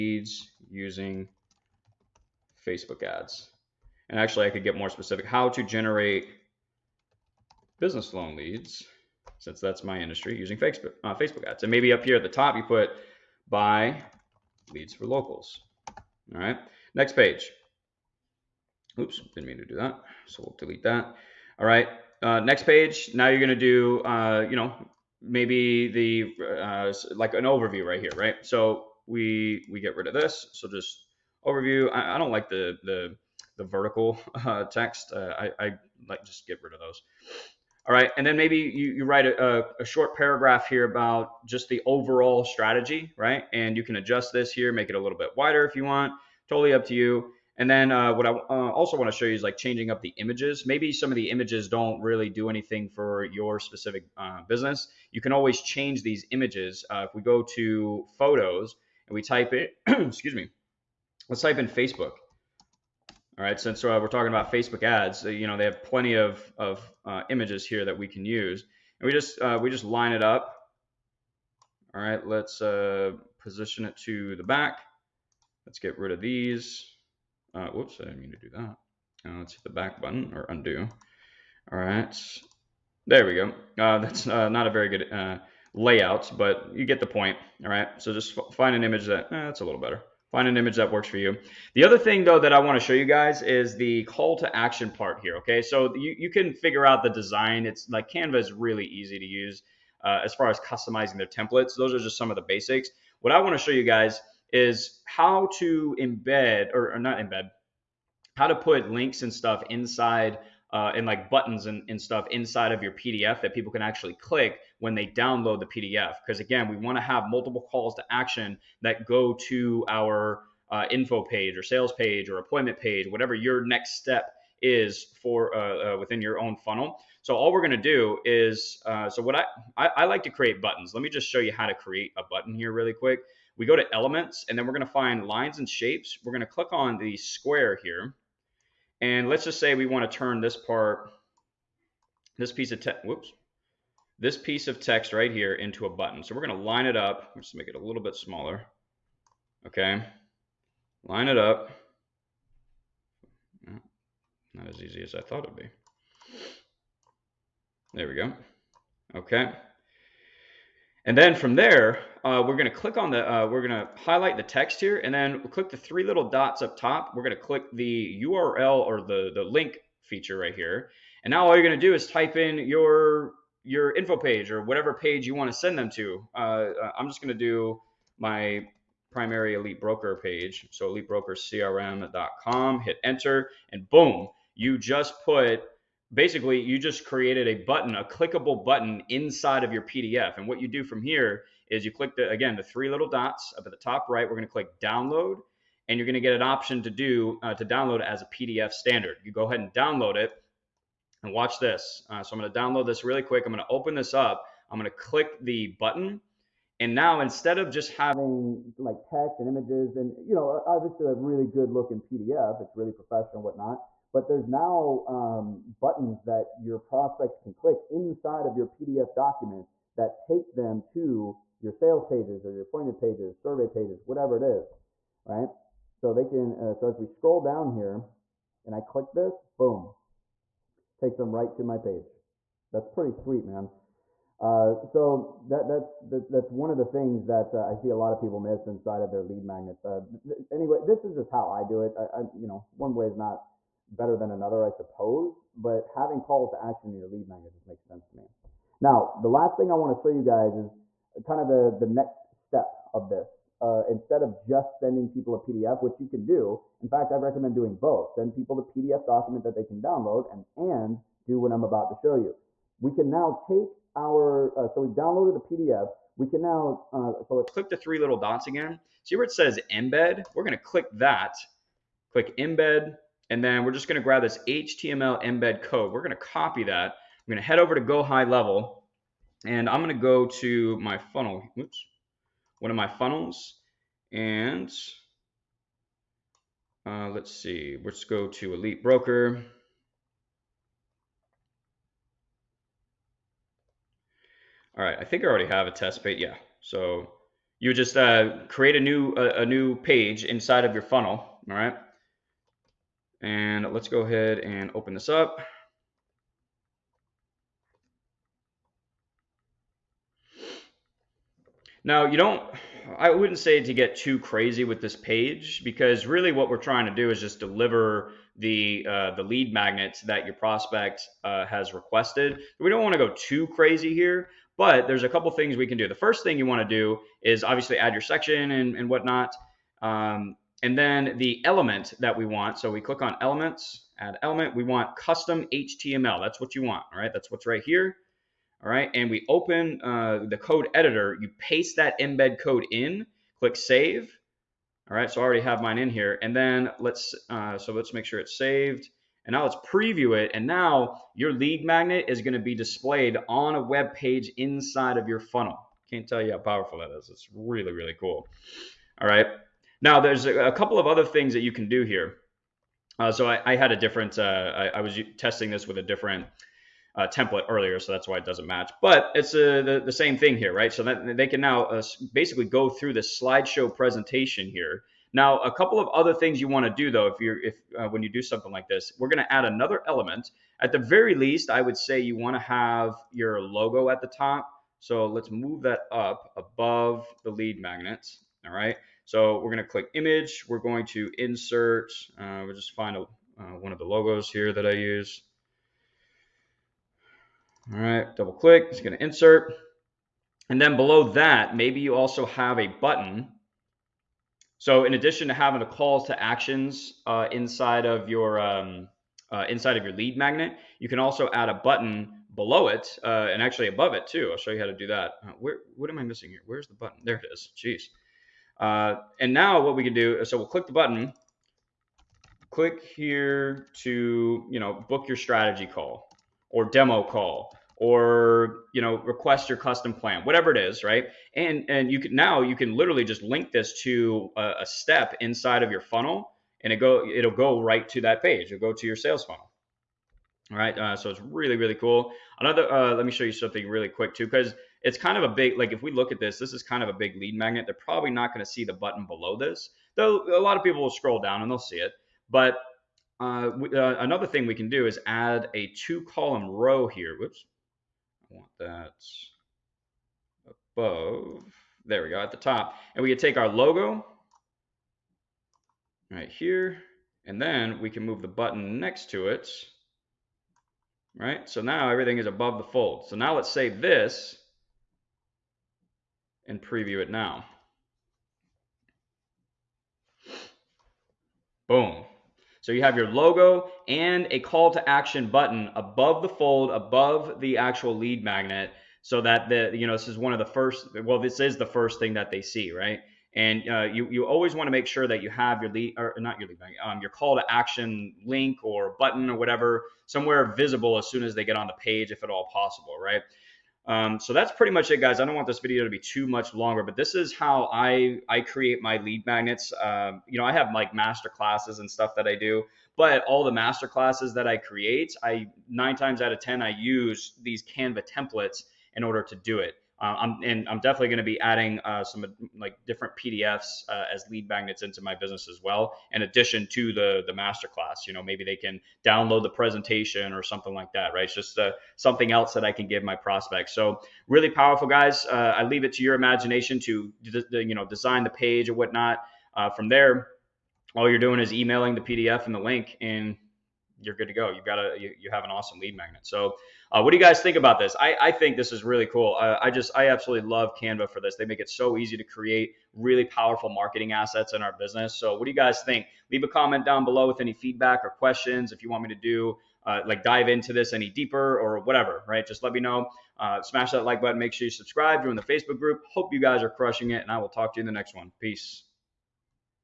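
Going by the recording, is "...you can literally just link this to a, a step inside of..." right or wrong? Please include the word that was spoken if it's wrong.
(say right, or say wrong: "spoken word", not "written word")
right.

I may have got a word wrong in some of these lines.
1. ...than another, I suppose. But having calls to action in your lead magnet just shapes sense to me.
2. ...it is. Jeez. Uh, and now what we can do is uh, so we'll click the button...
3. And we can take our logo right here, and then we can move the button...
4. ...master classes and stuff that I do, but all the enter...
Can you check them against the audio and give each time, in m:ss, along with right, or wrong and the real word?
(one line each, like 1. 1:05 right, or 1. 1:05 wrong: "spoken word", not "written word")
1. 4:04 wrong: "makes", not "shapes"
2. 6:57 right
3. 7:42 right
4. 8:30 wrong: "master", not "enter".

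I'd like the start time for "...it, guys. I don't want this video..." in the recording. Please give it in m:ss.
8:24.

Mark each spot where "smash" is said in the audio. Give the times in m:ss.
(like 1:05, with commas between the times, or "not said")
9:23.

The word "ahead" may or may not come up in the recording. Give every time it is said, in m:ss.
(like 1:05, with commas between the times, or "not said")
3:19, 5:04.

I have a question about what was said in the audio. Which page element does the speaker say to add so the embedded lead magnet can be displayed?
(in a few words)
custom HTML.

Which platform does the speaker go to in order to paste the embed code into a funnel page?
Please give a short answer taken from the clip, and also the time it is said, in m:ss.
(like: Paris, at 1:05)
Go High Level, at 4:37.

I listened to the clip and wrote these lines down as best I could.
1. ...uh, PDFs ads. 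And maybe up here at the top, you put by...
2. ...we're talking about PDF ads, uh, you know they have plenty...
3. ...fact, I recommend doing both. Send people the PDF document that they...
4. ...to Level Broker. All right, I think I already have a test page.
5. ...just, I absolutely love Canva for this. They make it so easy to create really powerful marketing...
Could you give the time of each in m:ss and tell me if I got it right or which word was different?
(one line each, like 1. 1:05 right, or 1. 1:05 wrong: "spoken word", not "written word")
1. 0:11 wrong: "Facebook", not "PDFs"
2. 1:04 wrong: "Facebook", not "PDF"
3. 4:16 right
4. 4:48 wrong: "Elite", not "Level"
5. 9:09 right.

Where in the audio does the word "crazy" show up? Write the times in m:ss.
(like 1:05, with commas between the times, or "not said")
5:14, 5:23.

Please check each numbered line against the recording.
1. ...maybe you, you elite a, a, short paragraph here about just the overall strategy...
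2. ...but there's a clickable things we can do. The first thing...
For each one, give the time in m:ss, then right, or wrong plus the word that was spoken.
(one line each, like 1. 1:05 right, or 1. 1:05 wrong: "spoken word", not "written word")
1. 0:38 wrong: "write", not "elite"
2. 5:24 wrong: "couple", not "clickable".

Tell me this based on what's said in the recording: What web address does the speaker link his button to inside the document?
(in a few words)
elitebrokercrm.com.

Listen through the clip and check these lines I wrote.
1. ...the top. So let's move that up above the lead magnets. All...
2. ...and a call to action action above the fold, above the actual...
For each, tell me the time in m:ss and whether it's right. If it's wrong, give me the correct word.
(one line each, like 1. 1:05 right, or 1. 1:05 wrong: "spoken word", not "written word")
1. 6:24 right
2. 8:03 wrong: "button", not "action".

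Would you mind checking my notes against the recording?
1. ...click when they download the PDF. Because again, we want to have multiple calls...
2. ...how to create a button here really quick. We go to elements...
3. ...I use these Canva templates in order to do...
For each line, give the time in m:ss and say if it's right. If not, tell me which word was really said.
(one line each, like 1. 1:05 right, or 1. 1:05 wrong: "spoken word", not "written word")
1. 1:54 right
2. 2:11 right
3. 8:36 right.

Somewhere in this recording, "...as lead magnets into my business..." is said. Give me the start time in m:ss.
8:44.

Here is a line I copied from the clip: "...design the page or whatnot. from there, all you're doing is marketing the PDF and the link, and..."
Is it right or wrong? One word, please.
wrong.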